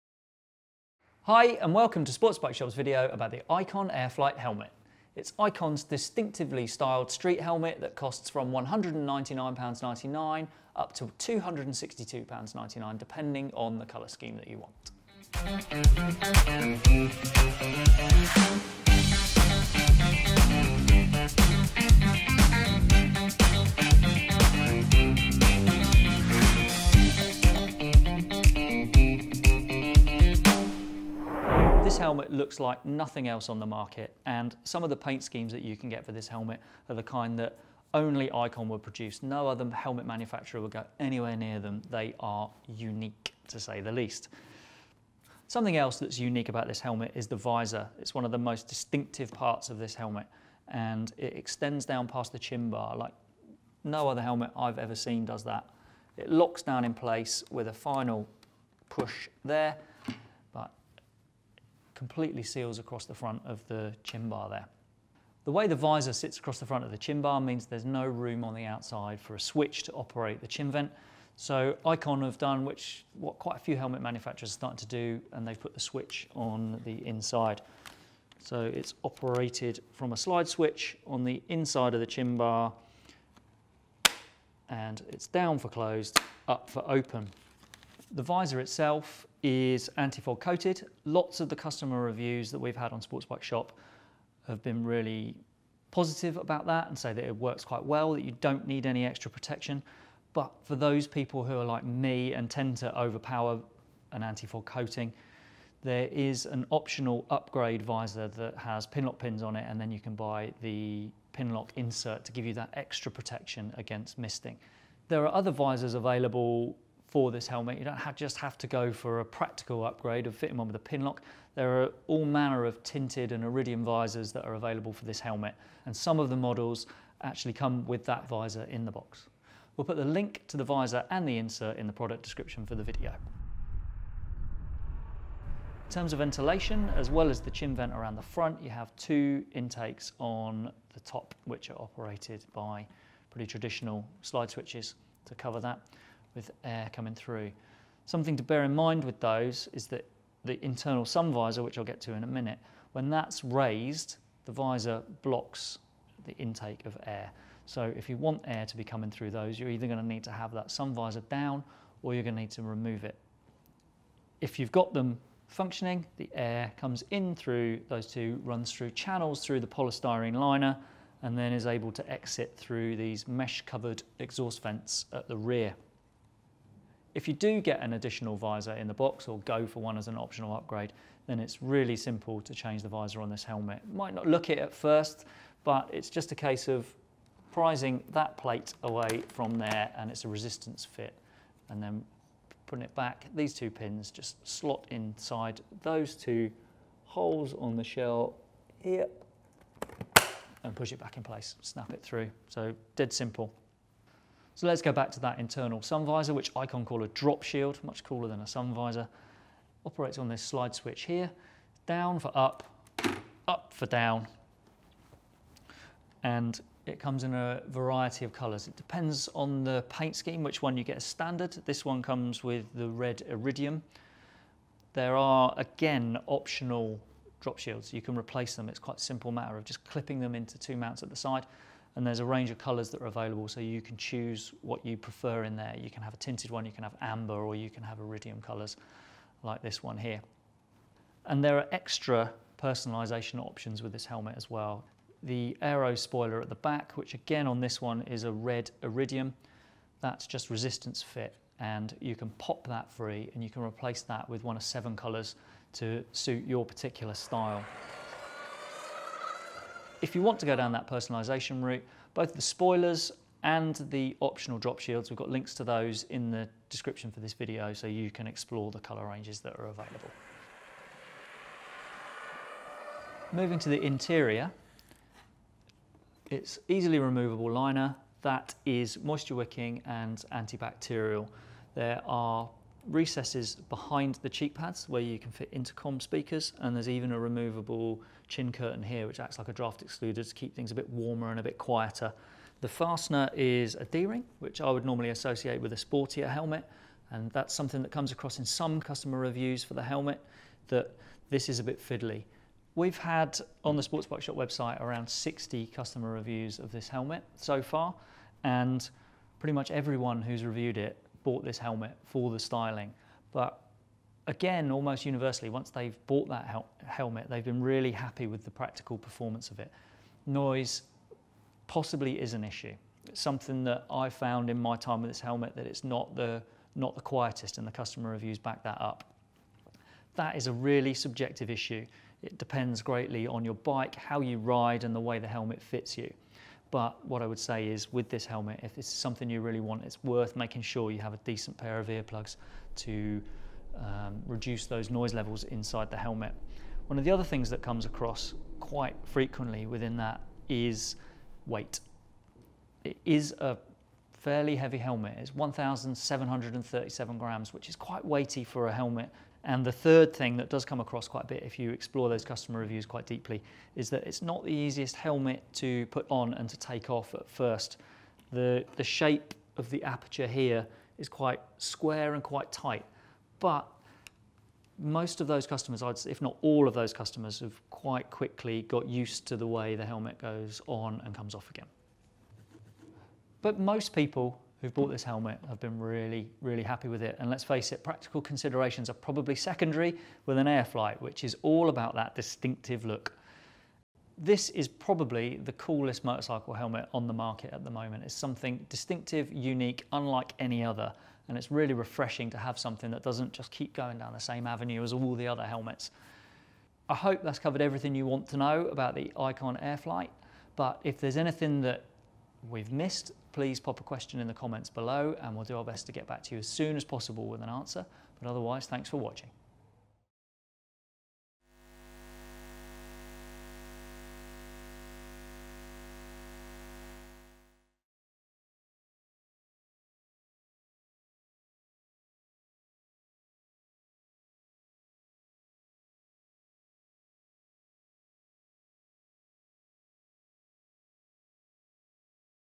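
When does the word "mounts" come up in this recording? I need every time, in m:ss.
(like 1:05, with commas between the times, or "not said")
3:50.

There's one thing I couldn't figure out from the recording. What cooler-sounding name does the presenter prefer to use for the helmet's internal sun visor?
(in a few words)
drop shield.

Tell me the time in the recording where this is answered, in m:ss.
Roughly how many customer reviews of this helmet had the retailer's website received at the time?
5:05.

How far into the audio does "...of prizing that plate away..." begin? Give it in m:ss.
3:06.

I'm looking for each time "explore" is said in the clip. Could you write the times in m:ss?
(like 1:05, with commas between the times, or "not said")
4:28, 6:01.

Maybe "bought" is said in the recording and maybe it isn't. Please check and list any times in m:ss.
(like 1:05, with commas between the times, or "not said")
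5:11, 5:16, 6:24.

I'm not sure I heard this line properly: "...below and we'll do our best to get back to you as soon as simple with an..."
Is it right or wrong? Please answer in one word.
wrong.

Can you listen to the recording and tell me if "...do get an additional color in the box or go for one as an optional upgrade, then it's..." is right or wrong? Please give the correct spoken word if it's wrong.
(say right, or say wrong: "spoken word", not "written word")
wrong: "visor", not "color".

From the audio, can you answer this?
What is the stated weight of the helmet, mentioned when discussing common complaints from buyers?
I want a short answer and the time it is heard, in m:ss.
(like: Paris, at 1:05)
1,737 grams, at 5:55.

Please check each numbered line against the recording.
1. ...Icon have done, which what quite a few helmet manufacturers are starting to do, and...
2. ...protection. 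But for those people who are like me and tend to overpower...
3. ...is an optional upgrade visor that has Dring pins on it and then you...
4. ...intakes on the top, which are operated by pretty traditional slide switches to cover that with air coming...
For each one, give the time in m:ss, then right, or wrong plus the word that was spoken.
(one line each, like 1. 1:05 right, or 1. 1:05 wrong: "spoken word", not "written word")
1. 1:11 right
2. 1:39 right
3. 1:46 wrong: "Pinlock", not "Dring"
4. 2:19 right.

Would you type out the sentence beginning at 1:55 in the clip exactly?
There are other visors available for this helmet.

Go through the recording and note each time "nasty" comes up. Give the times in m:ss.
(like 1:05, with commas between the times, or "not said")
not said.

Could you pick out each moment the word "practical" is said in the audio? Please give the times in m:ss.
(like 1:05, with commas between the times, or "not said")
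1:59, 5:18, 6:27.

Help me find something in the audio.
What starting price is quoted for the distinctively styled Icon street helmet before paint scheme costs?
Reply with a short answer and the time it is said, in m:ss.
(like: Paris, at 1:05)
£199.99, at 0:08.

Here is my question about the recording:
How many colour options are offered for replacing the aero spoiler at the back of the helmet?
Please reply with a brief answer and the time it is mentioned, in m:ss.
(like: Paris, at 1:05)
7, at 4:14.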